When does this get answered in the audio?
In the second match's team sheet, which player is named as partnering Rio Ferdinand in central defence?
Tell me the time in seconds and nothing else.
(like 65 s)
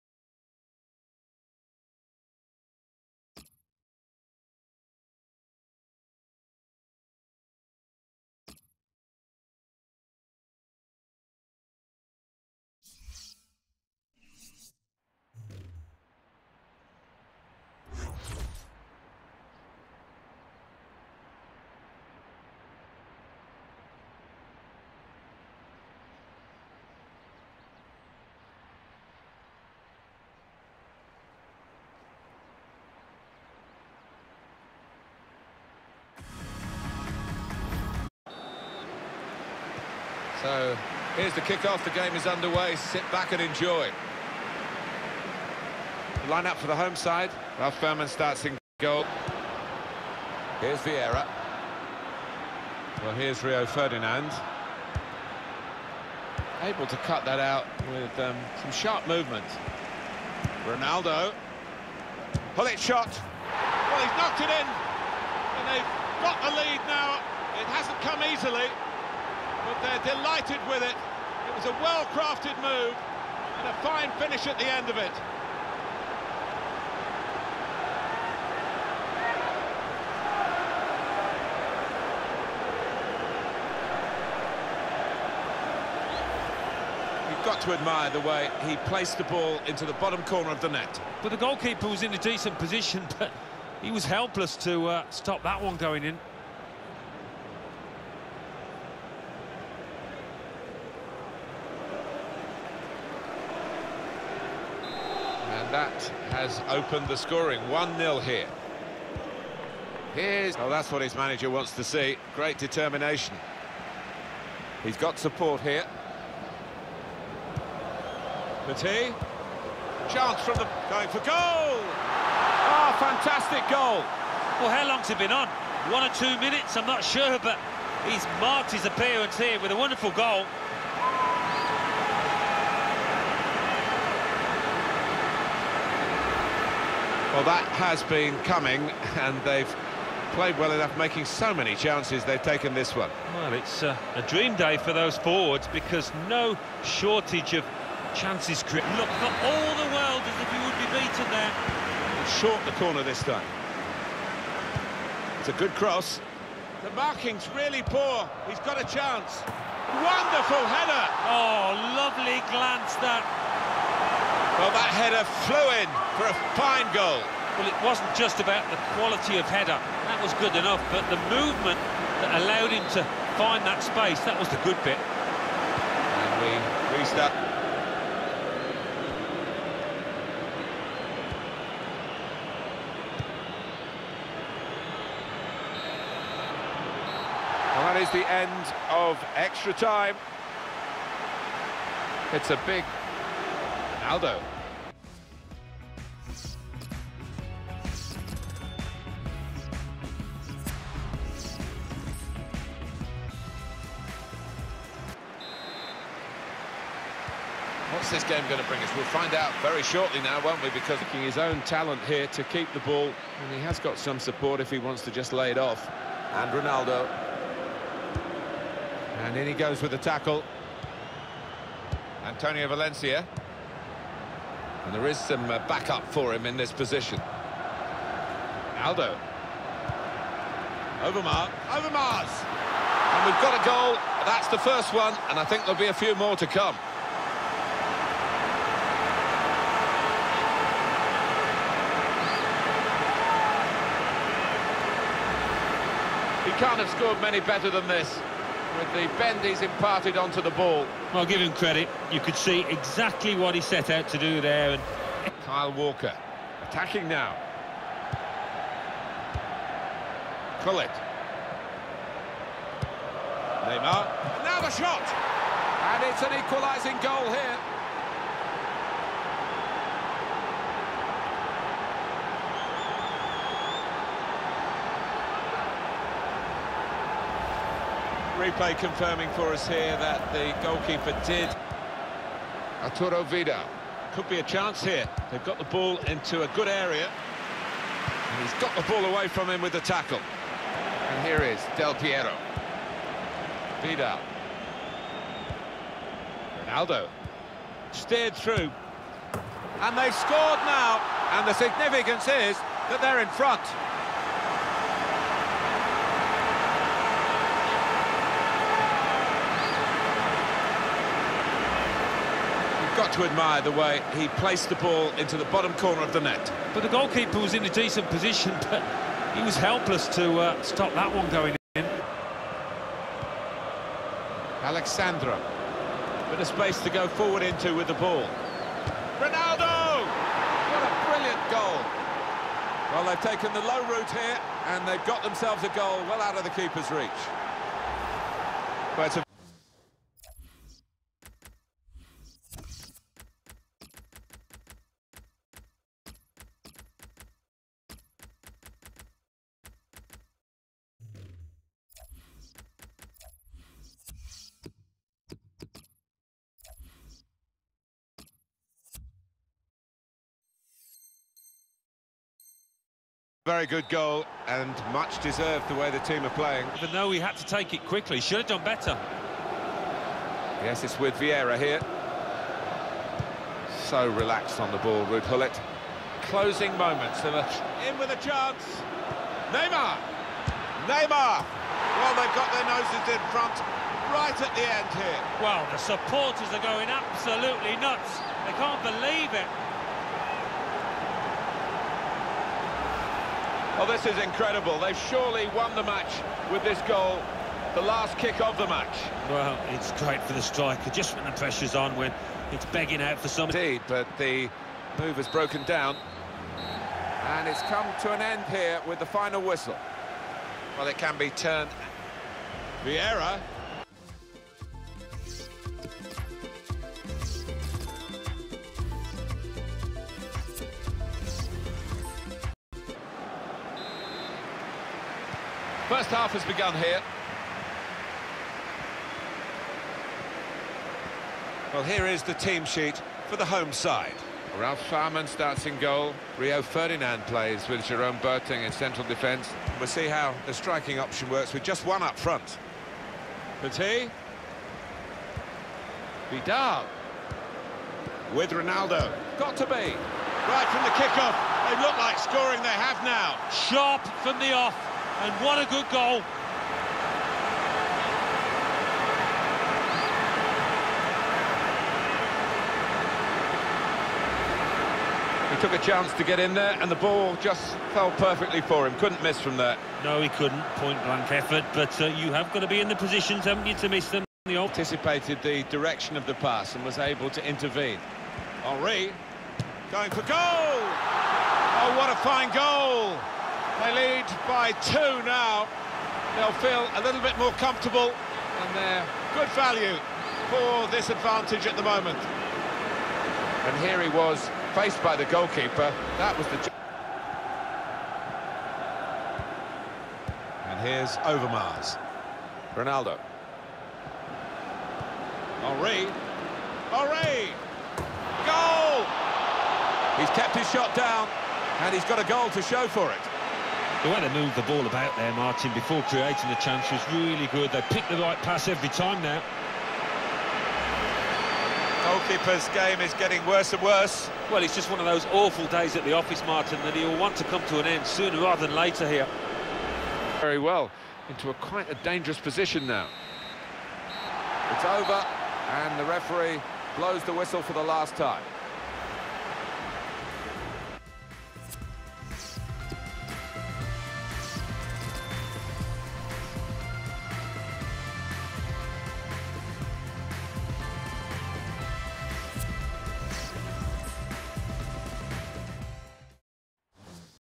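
437 s.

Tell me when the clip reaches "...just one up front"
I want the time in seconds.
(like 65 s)
441 s.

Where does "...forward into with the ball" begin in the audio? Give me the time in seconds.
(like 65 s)
327 s.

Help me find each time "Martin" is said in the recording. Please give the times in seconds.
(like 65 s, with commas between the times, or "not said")
515 s, 526 s.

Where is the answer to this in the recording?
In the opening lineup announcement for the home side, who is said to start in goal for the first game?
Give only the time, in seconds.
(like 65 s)
47 s.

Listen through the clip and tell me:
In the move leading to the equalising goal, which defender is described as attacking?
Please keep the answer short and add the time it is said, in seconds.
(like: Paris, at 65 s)
Kyle Walker, at 255 s.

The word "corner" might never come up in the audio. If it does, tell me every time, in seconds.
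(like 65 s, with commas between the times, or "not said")
90 s, 152 s, 315 s.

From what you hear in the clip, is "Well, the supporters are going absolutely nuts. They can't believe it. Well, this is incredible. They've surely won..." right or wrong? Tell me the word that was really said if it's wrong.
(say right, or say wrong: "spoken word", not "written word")
right.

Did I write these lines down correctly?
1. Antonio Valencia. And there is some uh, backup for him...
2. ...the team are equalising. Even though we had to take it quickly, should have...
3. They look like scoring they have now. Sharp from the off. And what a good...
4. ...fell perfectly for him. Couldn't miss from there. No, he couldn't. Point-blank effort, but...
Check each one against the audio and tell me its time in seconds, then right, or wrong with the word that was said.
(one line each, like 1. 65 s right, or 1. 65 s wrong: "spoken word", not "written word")
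1. 222 s right
2. 365 s wrong: "playing", not "equalising"
3. 451 s right
4. 467 s right.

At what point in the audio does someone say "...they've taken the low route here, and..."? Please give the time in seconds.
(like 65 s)
333 s.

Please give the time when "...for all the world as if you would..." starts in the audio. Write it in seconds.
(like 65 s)
148 s.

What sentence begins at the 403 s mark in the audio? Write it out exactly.
Indeed, but the move has broken down.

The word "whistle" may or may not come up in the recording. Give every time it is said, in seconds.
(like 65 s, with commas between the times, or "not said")
409 s, 537 s.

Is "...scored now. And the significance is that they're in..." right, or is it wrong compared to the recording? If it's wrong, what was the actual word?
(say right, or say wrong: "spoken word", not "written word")
right.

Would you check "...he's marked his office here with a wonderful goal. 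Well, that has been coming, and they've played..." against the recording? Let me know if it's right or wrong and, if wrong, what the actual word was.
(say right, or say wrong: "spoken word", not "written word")
wrong: "appearance", not "office".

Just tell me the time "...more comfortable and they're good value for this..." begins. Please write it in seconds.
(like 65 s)
487 s.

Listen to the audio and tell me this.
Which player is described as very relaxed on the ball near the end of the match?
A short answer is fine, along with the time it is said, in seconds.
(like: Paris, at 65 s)
Ruud Gullit, at 375 s.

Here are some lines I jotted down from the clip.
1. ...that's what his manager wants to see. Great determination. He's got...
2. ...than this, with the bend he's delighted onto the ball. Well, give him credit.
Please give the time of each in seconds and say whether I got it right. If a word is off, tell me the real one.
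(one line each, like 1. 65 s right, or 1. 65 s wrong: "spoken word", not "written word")
1. 110 s right
2. 247 s wrong: "imparted", not "delighted".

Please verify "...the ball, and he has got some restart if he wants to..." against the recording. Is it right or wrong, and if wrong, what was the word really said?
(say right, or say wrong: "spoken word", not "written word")
wrong: "support", not "restart".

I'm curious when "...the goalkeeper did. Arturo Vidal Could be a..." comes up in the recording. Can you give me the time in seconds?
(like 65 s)
280 s.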